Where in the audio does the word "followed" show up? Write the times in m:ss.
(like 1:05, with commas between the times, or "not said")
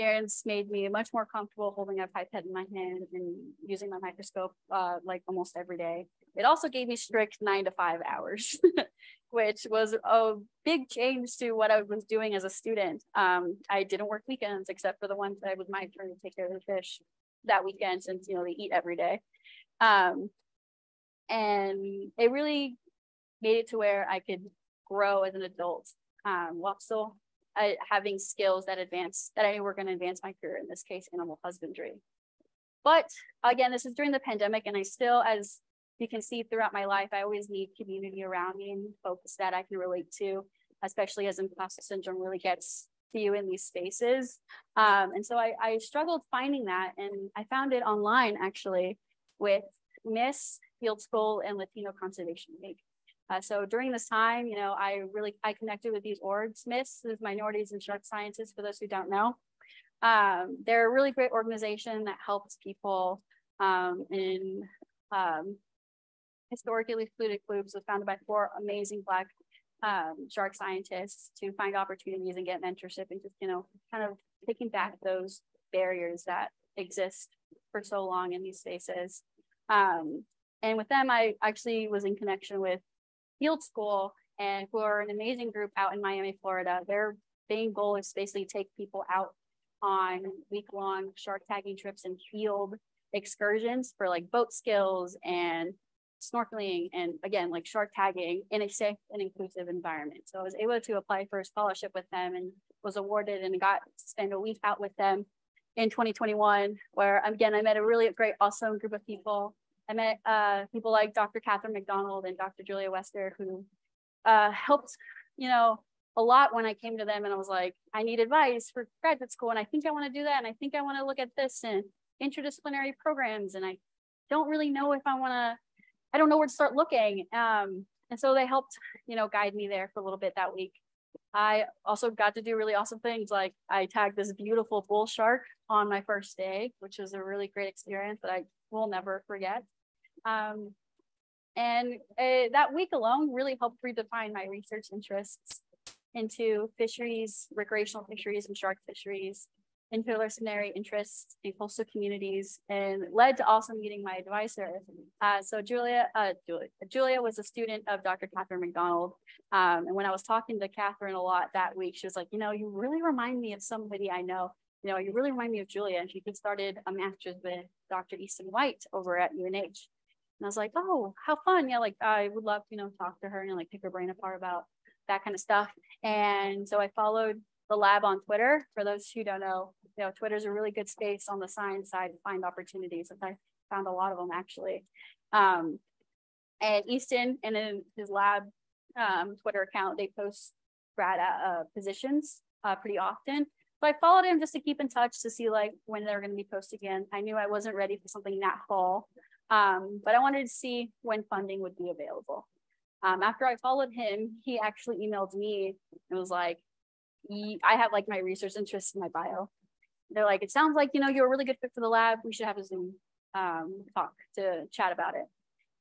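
2:56, 3:13, 3:23.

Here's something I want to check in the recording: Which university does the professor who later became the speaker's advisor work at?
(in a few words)
UNH.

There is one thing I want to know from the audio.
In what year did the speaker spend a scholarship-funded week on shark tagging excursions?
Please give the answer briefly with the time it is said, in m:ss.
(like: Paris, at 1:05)
2021, at 1:45.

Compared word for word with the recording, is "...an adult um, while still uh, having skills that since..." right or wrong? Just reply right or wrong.
wrong.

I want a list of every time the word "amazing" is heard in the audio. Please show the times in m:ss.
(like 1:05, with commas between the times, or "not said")
1:08, 1:25.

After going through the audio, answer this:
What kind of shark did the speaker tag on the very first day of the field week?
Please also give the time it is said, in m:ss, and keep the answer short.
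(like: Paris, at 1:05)
bull shark, at 2:14.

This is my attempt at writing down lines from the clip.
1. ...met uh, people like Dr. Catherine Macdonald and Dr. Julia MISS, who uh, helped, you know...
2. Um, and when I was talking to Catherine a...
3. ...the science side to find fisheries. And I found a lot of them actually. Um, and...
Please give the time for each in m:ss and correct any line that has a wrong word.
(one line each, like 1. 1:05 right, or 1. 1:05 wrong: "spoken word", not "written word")
1. 1:49 wrong: "Wester", not "MISS"
2. 2:39 right
3. 3:01 wrong: "opportunities", not "fisheries".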